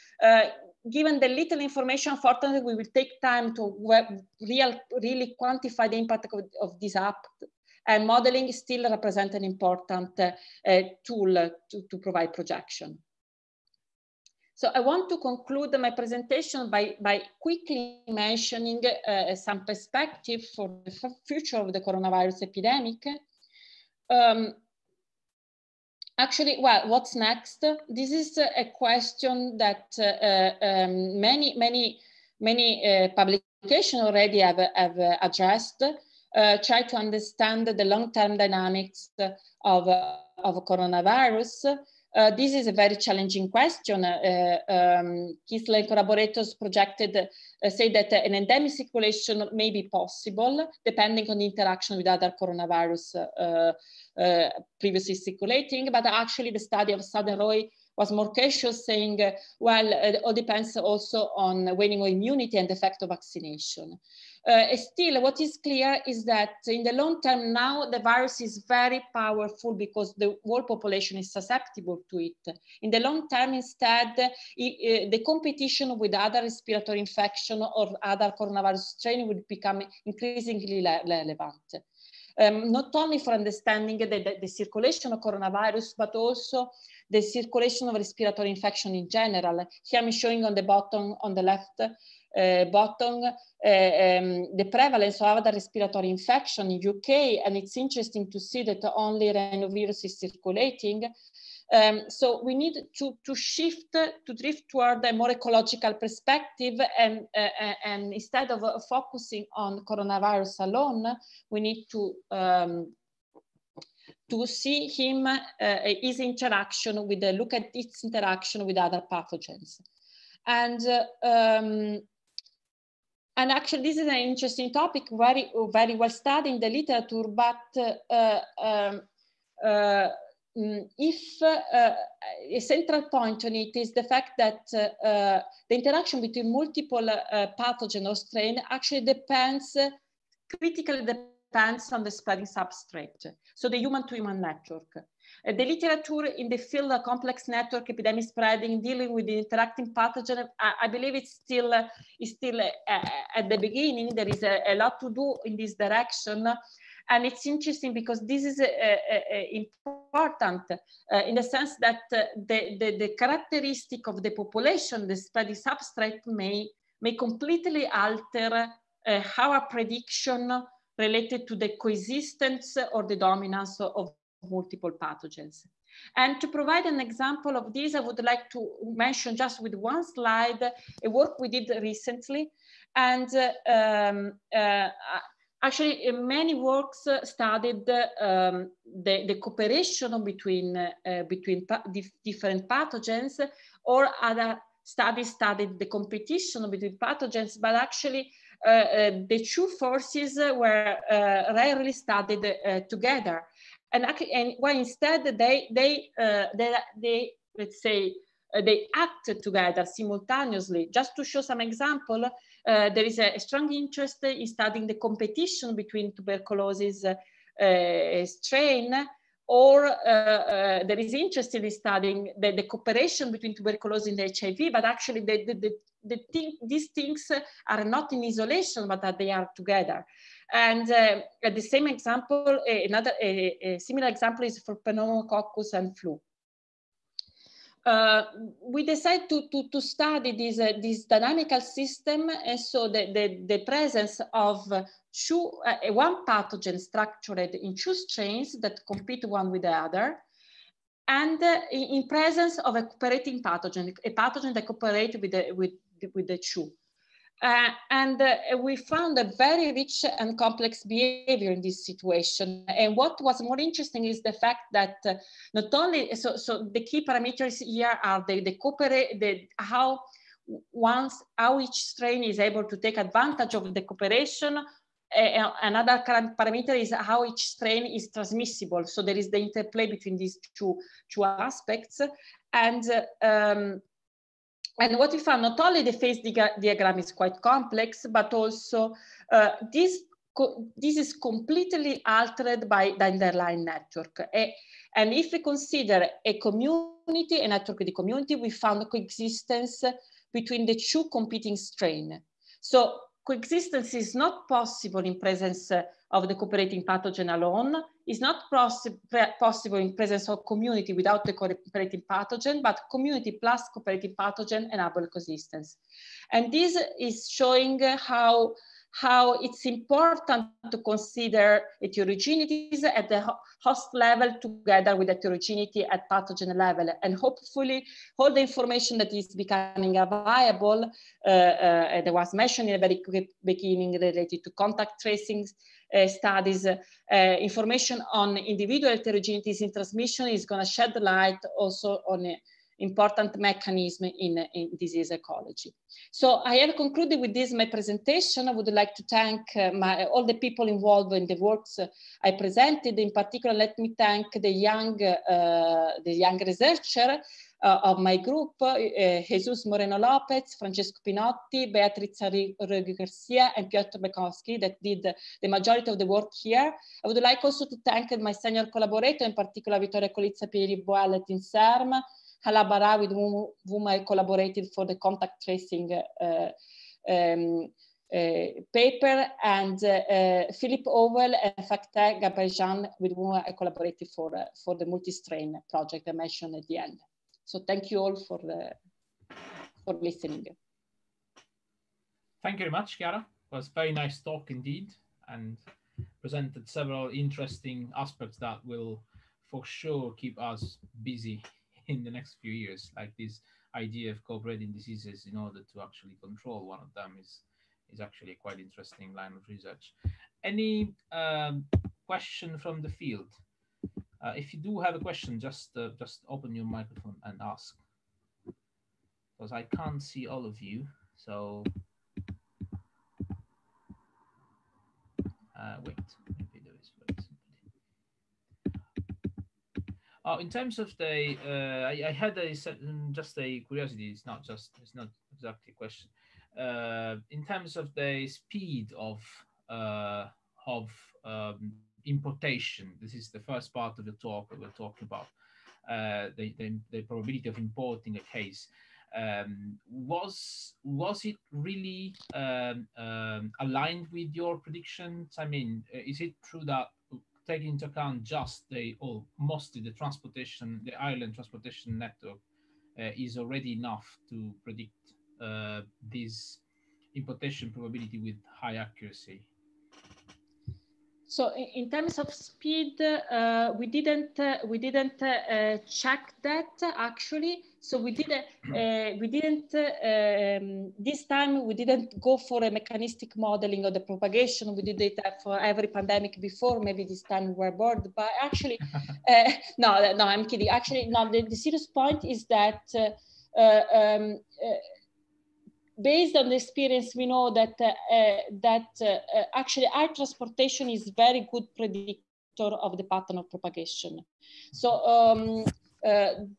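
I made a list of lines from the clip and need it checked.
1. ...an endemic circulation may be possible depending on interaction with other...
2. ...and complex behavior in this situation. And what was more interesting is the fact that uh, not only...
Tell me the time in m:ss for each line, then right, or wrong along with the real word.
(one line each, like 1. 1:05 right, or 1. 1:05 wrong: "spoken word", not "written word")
1. 0:48 right
2. 4:20 right.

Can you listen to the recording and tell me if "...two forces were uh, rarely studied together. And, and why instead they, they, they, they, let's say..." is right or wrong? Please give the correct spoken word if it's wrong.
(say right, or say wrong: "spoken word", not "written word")
right.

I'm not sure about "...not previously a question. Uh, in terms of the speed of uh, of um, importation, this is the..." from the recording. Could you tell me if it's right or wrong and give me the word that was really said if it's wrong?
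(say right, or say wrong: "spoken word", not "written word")
wrong: "exactly", not "previously".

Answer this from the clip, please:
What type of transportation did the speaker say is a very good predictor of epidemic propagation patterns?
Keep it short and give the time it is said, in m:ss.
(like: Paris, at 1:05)
Air transportation, at 8:19.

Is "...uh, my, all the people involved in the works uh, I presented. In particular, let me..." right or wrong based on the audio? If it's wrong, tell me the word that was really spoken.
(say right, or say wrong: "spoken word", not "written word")
right.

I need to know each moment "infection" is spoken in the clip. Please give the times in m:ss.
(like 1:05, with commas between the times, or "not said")
1:16, 1:28, 1:36.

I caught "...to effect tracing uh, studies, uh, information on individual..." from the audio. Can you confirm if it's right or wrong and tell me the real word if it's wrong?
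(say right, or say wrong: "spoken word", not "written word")
wrong: "contact", not "effect".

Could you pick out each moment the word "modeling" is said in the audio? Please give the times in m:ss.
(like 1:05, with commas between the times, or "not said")
0:08, 8:03.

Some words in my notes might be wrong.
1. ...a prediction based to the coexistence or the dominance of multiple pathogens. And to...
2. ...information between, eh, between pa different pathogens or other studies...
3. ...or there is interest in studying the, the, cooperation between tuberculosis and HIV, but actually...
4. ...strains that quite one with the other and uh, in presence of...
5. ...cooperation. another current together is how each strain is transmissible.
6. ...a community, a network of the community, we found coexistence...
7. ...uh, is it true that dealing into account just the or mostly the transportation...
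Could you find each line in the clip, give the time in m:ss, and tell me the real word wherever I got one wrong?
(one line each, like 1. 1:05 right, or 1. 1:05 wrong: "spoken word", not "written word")
1. 2:49 wrong: "related", not "based"
2. 3:09 wrong: "cooperation", not "information"
3. 3:39 right
4. 4:07 wrong: "compete", not "quite"
5. 4:33 wrong: "parameter", not "together"
6. 4:56 right
7. 7:35 wrong: "taking", not "dealing".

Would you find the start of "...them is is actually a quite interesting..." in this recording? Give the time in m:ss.
6:46.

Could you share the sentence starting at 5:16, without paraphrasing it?
And this is showing how how it's important to consider heterogeneities at the host level together with heterogeneity at pathogen level.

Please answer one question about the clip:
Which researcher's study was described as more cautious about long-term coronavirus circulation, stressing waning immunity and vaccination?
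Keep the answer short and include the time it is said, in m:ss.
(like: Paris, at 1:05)
Saad-Roy, at 0:57.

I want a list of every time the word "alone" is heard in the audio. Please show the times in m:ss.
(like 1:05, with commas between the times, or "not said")
1:50, 5:07.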